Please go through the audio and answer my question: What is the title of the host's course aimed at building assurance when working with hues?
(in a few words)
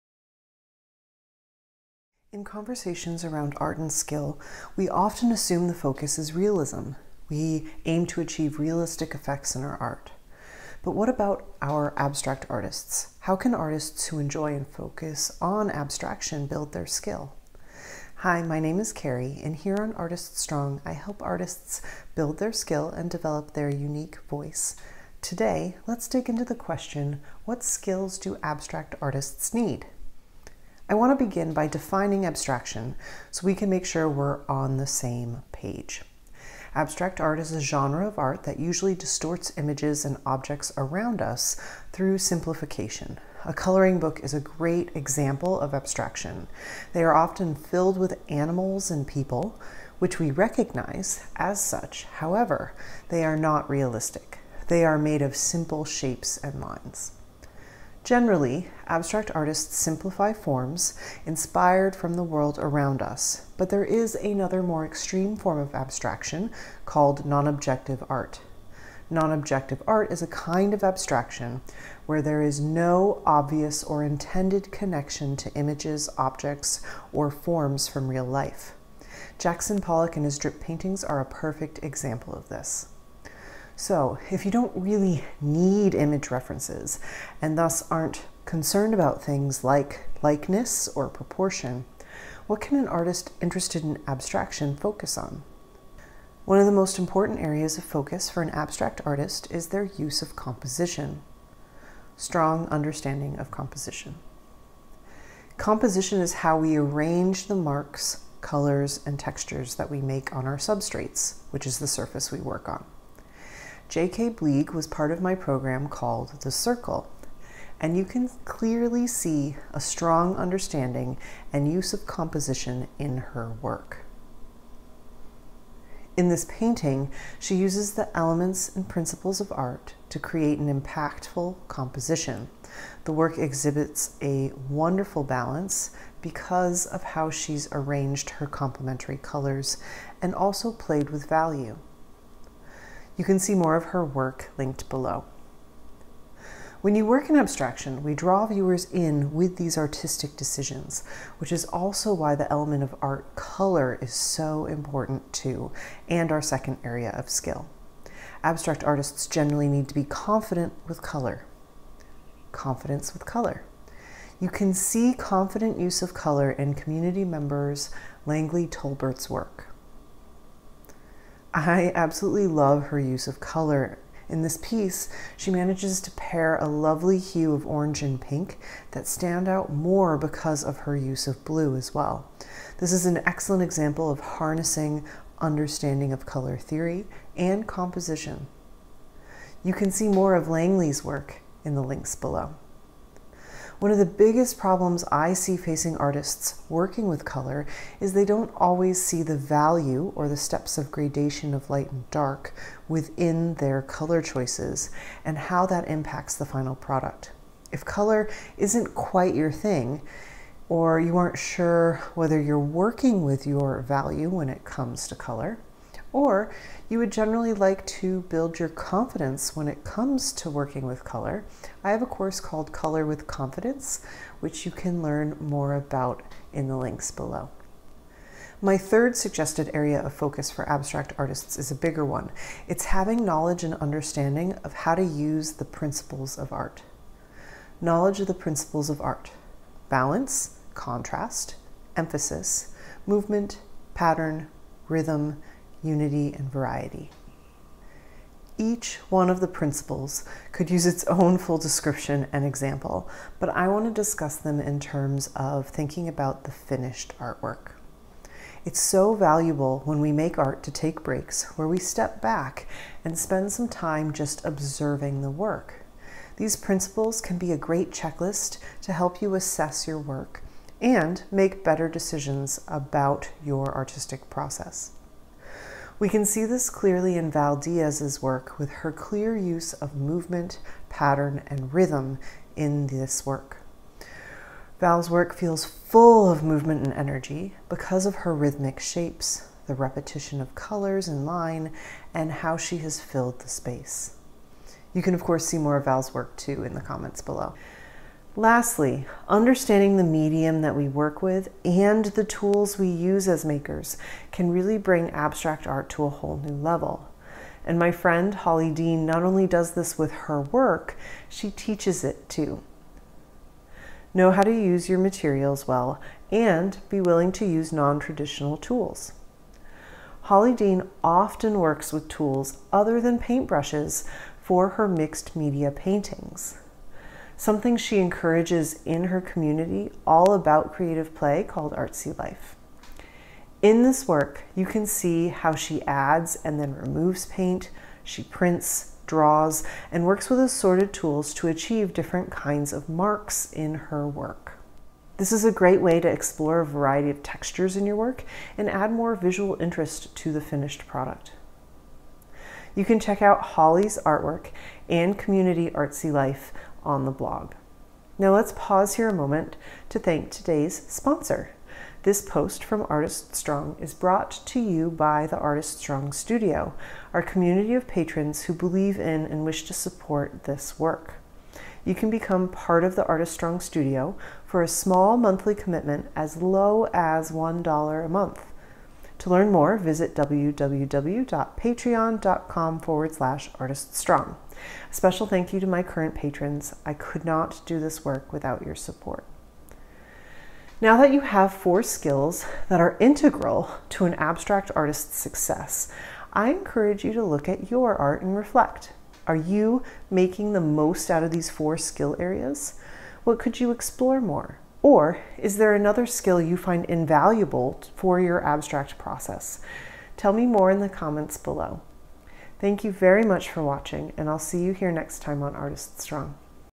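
Color with Confidence.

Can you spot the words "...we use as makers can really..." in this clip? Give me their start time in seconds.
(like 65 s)
302 s.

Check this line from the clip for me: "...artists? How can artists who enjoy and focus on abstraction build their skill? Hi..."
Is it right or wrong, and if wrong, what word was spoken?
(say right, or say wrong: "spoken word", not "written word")
right.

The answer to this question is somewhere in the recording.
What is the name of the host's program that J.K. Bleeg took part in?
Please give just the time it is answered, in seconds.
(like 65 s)
116 s.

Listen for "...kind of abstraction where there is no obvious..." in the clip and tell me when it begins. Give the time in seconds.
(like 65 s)
70 s.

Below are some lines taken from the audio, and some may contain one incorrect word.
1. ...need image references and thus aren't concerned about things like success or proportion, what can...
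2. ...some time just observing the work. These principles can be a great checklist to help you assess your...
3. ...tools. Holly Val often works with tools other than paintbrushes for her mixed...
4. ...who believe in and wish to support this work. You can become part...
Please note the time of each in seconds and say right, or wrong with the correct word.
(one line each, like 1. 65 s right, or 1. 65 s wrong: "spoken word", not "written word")
1. 85 s wrong: "likeness", not "success"
2. 263 s right
3. 318 s wrong: "Dean", not "Val"
4. 368 s right.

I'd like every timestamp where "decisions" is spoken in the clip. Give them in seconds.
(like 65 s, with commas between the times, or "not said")
150 s, 271 s.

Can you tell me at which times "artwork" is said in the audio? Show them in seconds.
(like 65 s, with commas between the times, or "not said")
257 s, 354 s.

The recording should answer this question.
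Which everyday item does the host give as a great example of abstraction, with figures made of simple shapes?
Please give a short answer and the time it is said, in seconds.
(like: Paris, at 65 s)
A coloring book, at 43 s.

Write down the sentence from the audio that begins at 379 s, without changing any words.
To learn more, visit www.patreon.com forward slash artiststrong.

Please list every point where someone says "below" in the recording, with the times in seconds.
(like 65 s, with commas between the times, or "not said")
144 s, 192 s, 227 s, 297 s, 411 s.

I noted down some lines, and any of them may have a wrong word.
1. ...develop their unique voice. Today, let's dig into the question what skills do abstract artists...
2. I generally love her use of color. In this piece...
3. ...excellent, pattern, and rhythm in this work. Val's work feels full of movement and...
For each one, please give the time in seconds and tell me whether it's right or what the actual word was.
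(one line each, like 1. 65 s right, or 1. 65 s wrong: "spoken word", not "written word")
1. 23 s right
2. 171 s wrong: "absolutely", not "generally"
3. 279 s wrong: "movement", not "excellent".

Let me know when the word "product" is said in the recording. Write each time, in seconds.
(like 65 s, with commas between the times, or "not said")
206 s, 350 s.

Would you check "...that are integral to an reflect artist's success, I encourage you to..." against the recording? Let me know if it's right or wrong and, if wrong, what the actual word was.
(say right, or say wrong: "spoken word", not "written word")
wrong: "abstract", not "reflect".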